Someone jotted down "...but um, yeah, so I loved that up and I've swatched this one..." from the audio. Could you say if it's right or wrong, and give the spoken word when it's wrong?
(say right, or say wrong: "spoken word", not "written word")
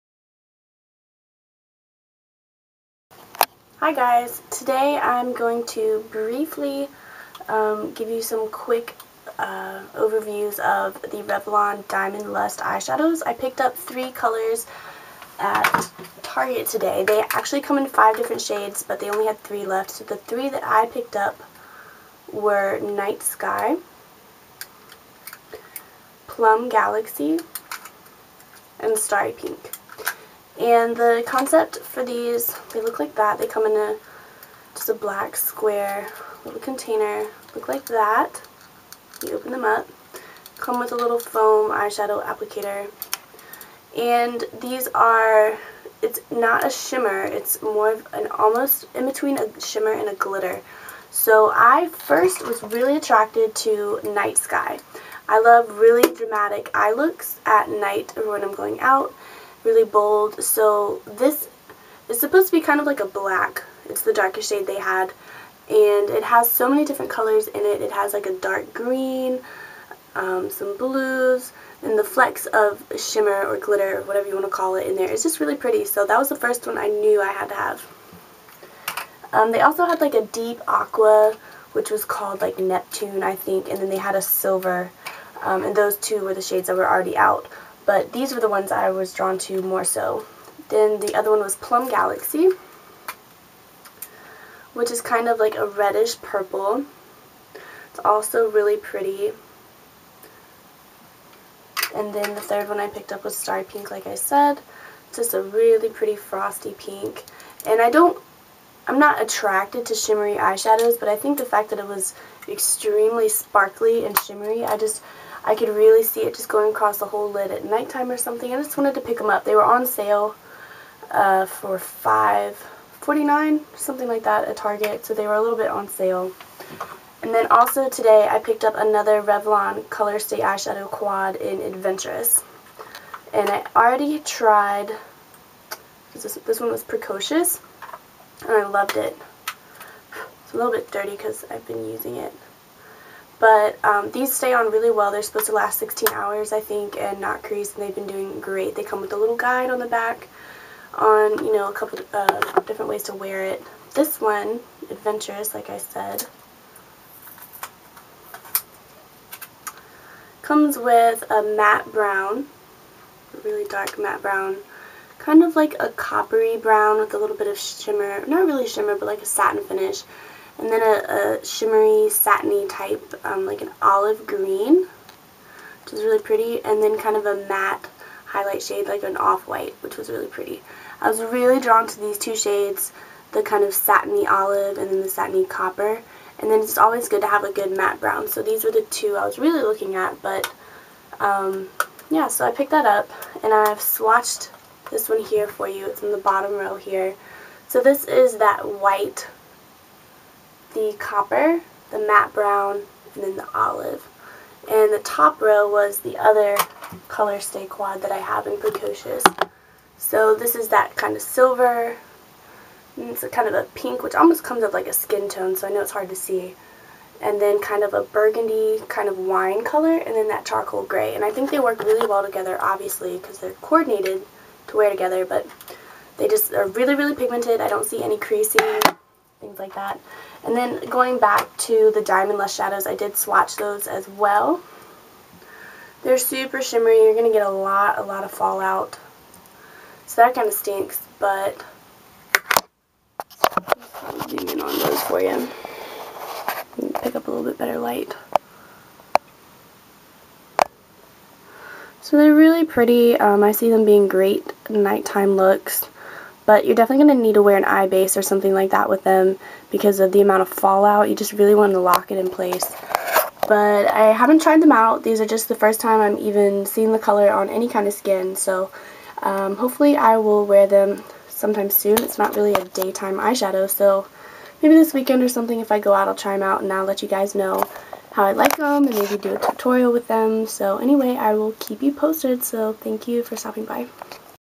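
wrong: "picked", not "loved".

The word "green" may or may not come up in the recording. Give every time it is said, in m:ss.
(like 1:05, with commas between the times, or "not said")
1:08, 2:54.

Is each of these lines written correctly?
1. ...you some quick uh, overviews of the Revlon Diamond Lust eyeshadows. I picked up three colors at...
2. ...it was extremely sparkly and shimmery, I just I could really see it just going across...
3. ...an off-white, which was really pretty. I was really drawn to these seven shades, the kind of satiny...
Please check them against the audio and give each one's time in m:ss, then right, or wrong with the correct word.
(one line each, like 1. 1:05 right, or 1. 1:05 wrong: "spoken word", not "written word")
1. 0:08 right
2. 1:51 right
3. 2:59 wrong: "two", not "seven".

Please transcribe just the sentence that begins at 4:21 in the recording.
You just really want to lock it in place.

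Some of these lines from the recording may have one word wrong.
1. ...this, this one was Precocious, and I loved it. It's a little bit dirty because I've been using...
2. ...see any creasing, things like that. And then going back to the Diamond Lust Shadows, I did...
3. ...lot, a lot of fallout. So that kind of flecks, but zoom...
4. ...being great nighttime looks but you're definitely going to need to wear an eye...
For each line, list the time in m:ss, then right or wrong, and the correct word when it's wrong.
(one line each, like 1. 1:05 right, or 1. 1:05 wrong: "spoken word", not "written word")
1. 2:16 right
2. 3:47 right
3. 3:57 wrong: "stinks", not "flecks"
4. 4:13 right.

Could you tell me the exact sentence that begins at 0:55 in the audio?
I love really dramatic eye looks at night or when I'm going out really bold.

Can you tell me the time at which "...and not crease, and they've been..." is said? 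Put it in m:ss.
2:26.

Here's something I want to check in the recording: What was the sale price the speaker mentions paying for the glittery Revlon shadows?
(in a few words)
$5.49.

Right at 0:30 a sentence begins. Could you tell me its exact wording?
And the concept for these, they look like that.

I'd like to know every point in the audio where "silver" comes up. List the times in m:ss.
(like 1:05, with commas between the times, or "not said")
1:24, 3:31.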